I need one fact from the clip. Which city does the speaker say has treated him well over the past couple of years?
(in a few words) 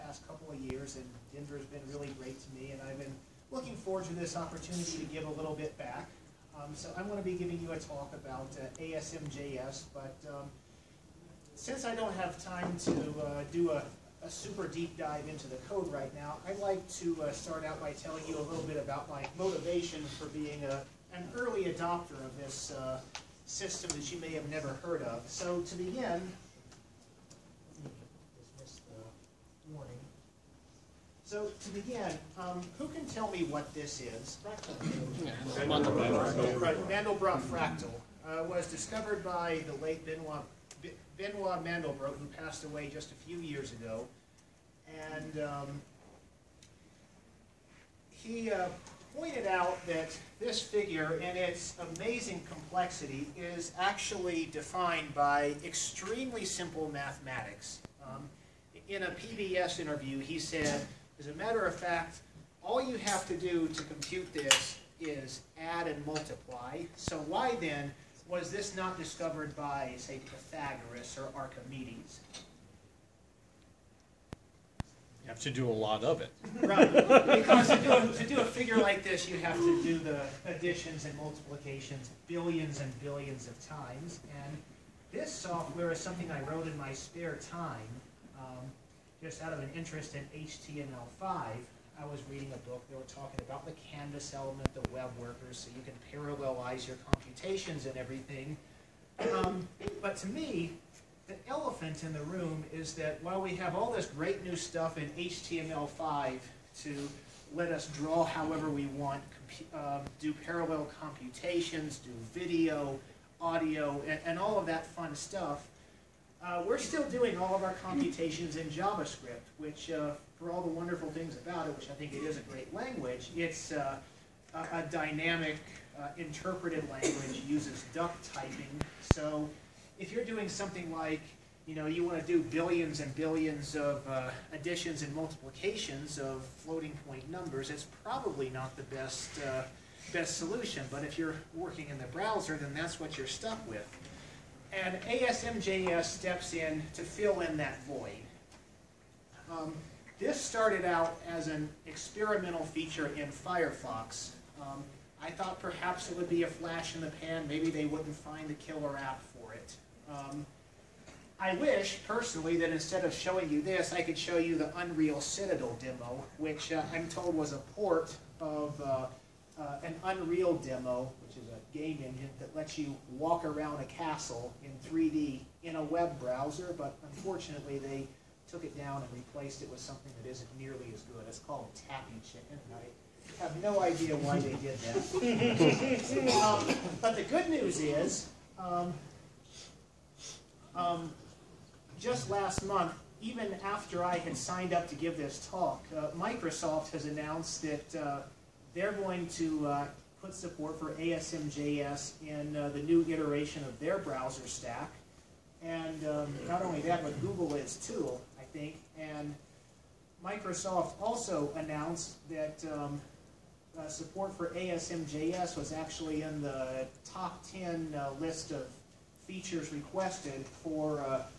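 Denver.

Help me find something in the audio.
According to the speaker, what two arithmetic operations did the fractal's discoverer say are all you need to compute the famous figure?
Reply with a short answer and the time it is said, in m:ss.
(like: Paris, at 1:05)
add and multiply, at 1:05.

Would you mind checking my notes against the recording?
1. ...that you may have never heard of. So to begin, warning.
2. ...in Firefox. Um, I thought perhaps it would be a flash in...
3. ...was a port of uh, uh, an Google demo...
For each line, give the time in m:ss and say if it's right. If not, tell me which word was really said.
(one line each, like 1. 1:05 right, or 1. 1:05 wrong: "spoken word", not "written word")
1. 0:23 right
2. 2:33 right
3. 2:47 wrong: "Unreal", not "Google".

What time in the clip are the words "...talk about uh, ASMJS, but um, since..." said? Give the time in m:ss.
0:07.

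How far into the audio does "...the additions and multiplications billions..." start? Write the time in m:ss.
1:19.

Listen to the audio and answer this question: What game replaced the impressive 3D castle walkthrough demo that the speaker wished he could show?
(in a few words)
Tappy Chicken.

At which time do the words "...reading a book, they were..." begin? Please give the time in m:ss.
1:32.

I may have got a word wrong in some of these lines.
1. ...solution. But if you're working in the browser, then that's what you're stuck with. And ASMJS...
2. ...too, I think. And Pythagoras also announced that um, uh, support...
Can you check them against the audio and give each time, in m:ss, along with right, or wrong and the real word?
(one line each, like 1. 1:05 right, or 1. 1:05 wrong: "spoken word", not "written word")
1. 2:20 right
2. 3:27 wrong: "Microsoft", not "Pythagoras".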